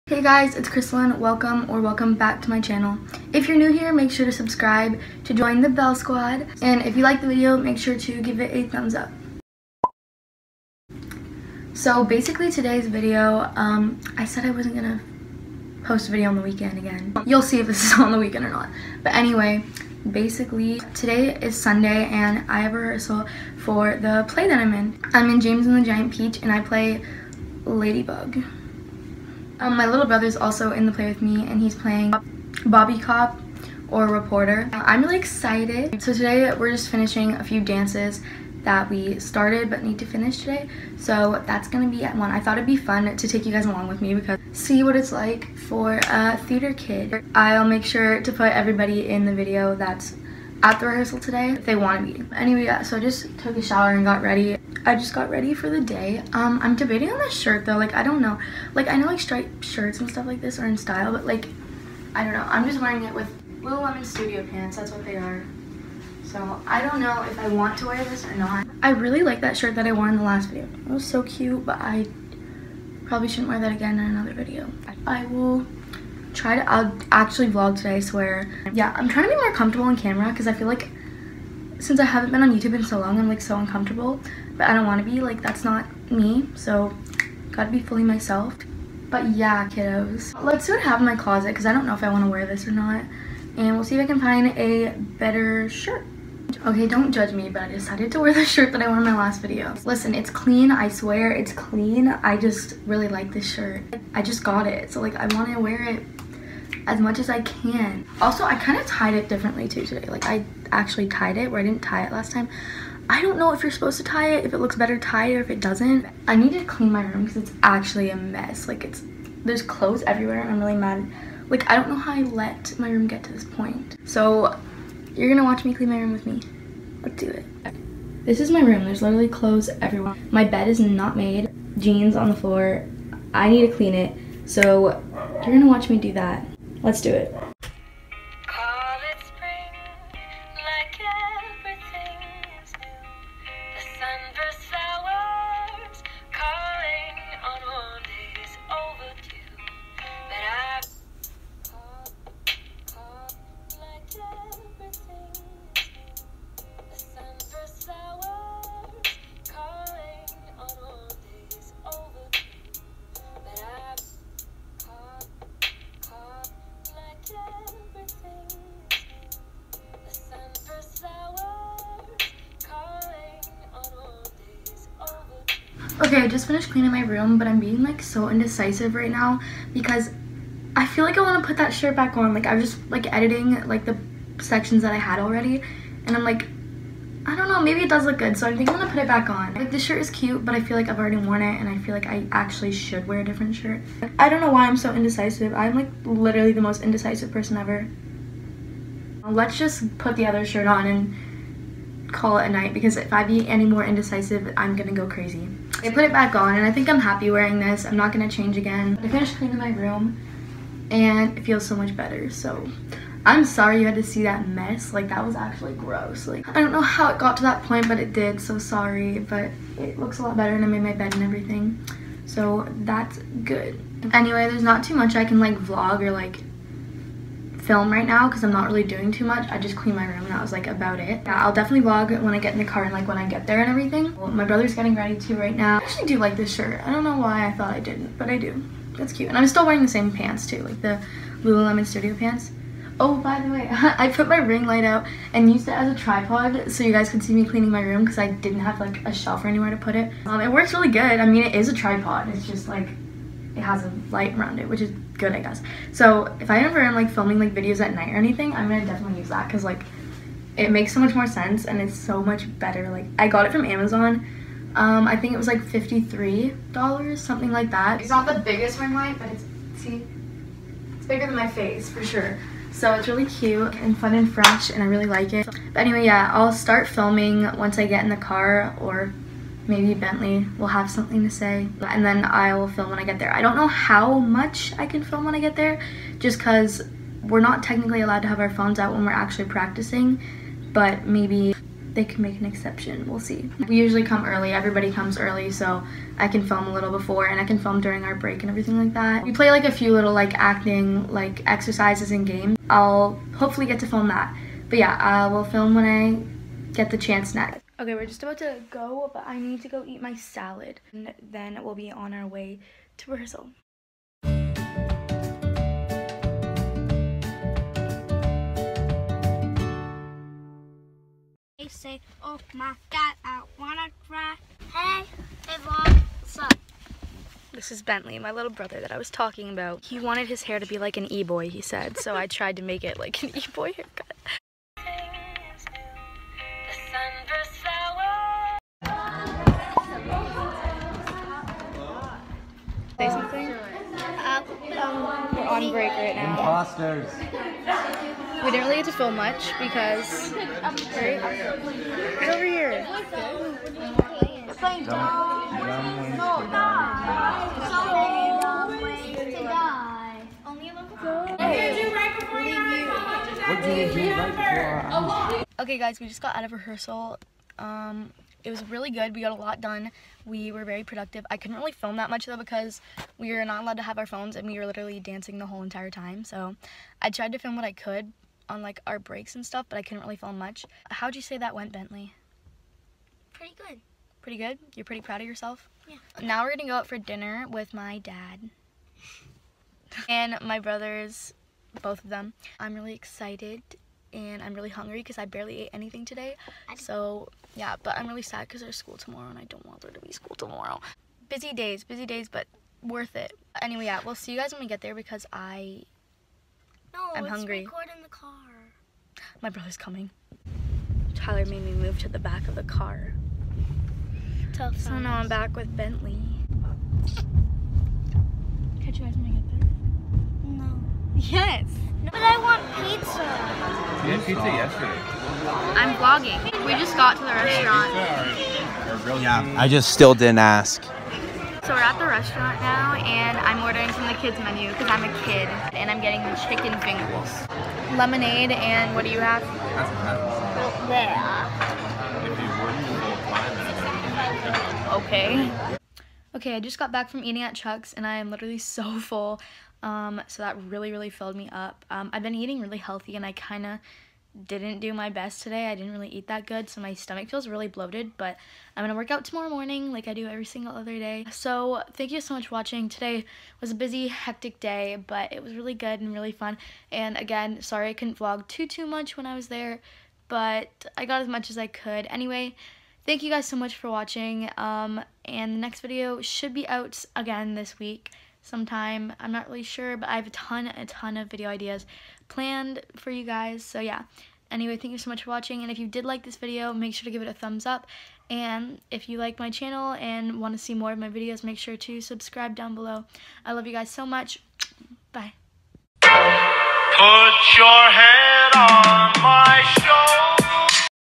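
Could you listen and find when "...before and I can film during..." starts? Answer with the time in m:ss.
4:56.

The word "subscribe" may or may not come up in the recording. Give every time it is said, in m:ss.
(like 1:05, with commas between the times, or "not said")
0:04, 8:12.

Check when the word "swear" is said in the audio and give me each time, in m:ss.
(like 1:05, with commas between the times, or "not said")
1:17, 1:40.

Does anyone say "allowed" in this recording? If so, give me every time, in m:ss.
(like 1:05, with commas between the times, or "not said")
4:48, 6:13.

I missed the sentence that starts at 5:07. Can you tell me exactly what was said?
Okay, we're just about to go, but I need to go eat my salad.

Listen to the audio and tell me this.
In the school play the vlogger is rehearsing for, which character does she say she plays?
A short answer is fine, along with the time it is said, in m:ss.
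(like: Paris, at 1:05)
Ladybug, at 0:27.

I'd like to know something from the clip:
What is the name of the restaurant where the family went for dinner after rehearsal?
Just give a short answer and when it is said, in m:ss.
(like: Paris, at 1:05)
Chuck's, at 7:27.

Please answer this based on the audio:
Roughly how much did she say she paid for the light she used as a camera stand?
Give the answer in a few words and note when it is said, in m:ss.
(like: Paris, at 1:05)
$53, at 4:25.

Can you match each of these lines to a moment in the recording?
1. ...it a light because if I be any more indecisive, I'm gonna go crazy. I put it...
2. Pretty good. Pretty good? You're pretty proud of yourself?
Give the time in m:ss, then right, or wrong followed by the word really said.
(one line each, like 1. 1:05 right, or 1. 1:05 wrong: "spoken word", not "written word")
1. 3:22 wrong: "night", not "light"
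2. 6:23 right.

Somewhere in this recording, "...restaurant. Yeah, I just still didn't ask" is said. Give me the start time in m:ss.
7:07.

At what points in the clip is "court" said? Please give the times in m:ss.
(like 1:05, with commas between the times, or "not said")
not said.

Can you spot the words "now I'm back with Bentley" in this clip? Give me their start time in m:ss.
6:55.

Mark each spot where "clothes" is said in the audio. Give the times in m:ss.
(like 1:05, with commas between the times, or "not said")
1:59, 2:09.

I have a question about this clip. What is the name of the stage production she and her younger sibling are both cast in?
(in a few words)
James and the Giant Peach.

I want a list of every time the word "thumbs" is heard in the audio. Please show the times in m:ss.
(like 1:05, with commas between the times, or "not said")
0:08, 8:07.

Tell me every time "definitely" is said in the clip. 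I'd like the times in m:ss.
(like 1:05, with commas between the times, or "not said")
3:51, 4:18.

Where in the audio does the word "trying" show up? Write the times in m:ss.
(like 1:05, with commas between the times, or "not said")
1:19.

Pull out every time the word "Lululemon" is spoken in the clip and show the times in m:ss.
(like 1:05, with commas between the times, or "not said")
1:03, 4:01.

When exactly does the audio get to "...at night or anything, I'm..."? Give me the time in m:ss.
4:17.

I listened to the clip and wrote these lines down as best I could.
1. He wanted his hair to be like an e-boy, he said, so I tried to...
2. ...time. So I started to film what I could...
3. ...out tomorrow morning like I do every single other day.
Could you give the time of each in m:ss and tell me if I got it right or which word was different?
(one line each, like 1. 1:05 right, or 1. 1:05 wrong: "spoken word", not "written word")
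1. 5:29 right
2. 6:15 wrong: "tried", not "started"
3. 7:39 right.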